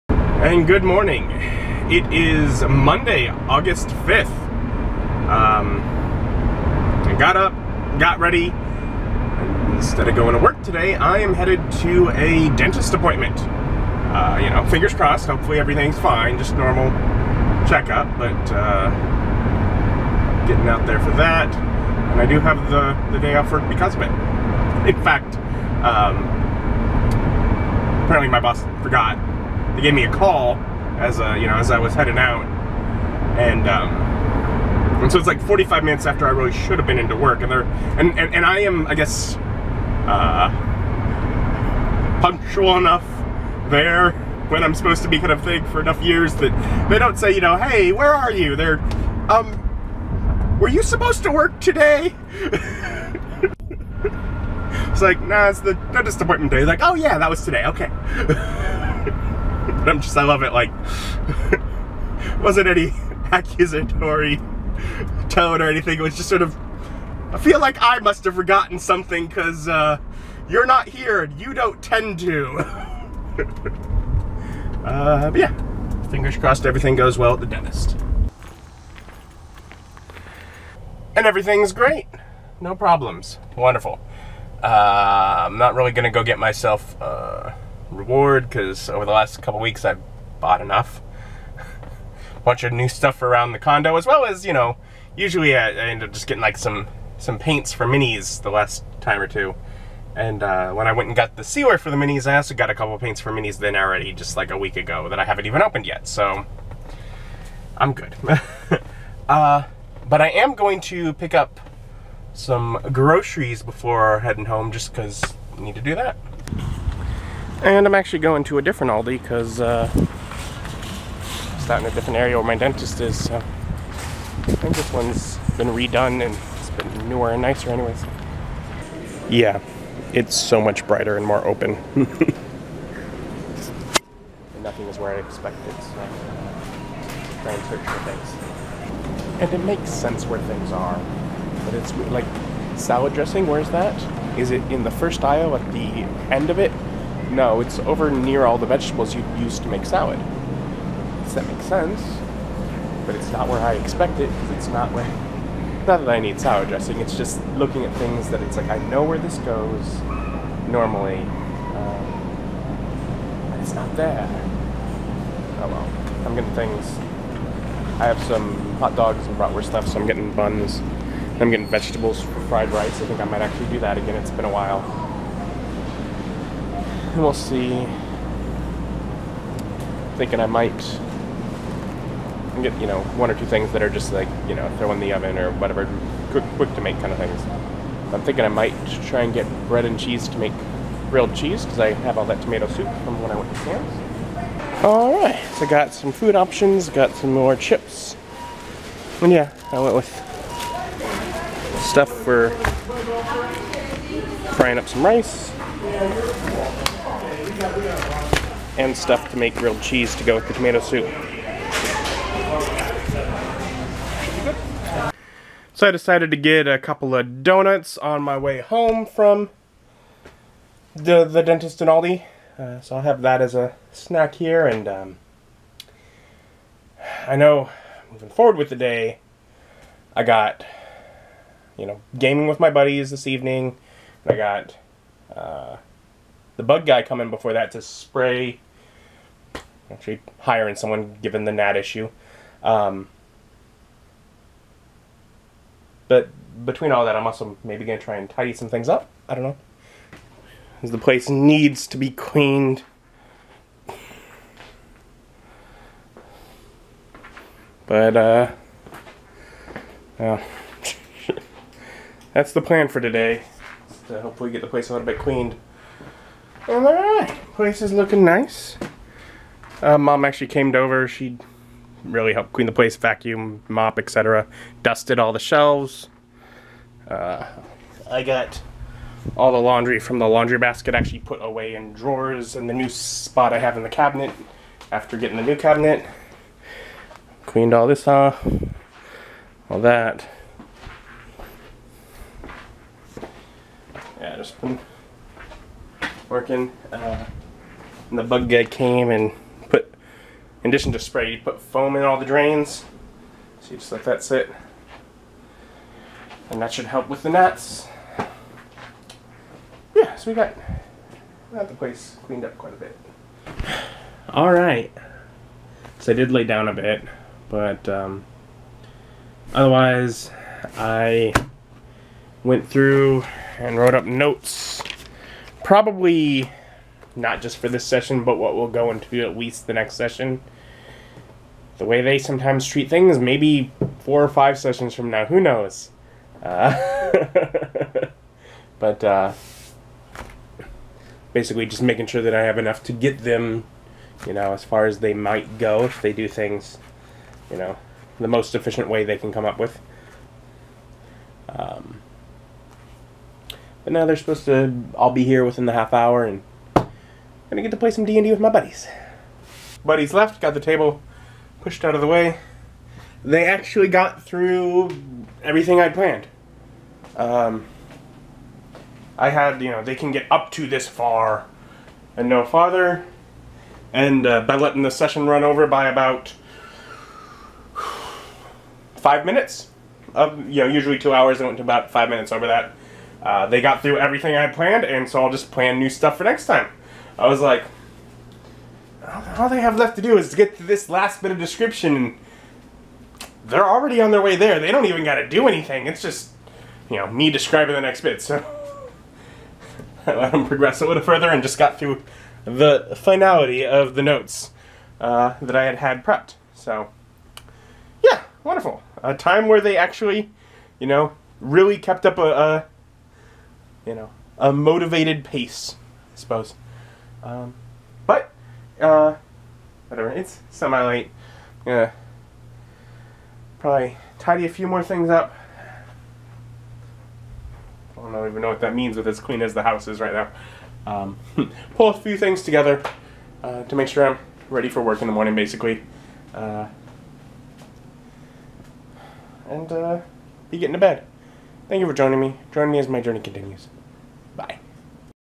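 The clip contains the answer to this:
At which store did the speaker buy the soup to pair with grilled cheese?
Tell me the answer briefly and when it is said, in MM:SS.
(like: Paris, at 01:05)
Sam's, at 03:13.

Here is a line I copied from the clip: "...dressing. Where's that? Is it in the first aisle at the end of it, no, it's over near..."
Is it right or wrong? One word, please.
right.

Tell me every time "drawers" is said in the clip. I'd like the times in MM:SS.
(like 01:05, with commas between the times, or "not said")
04:41.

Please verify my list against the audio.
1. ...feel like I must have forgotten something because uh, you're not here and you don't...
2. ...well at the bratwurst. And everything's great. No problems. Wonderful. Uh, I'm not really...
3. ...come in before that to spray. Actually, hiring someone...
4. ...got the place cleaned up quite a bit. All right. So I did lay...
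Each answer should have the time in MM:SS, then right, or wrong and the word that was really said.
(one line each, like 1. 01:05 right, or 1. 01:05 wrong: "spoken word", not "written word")
1. 01:07 right
2. 01:17 wrong: "dentist", not "bratwurst"
3. 03:57 right
4. 05:11 right.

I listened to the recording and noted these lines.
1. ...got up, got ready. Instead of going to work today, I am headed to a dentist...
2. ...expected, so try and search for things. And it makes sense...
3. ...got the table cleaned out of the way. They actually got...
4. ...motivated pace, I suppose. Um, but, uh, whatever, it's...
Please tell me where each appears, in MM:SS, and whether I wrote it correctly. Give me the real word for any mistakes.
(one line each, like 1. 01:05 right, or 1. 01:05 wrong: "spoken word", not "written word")
1. 00:07 right
2. 02:15 right
3. 06:00 wrong: "pushed", not "cleaned"
4. 06:54 right.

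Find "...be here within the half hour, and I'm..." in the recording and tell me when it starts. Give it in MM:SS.
05:55.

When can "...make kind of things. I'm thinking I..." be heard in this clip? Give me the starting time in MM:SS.
03:06.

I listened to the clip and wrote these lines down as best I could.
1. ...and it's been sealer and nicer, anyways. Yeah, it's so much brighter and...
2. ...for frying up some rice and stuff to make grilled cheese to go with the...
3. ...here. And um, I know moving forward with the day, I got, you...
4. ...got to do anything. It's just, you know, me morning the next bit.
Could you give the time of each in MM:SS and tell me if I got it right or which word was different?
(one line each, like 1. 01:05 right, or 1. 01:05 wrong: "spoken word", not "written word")
1. 02:06 wrong: "newer", not "sealer"
2. 03:22 right
3. 03:44 right
4. 06:35 wrong: "describing", not "morning".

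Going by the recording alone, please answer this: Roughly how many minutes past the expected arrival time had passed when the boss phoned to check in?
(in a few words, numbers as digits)
45 minutes.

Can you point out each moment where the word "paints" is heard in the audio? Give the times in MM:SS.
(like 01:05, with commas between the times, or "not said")
01:37, 01:42.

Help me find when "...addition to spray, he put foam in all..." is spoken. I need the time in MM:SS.
05:00.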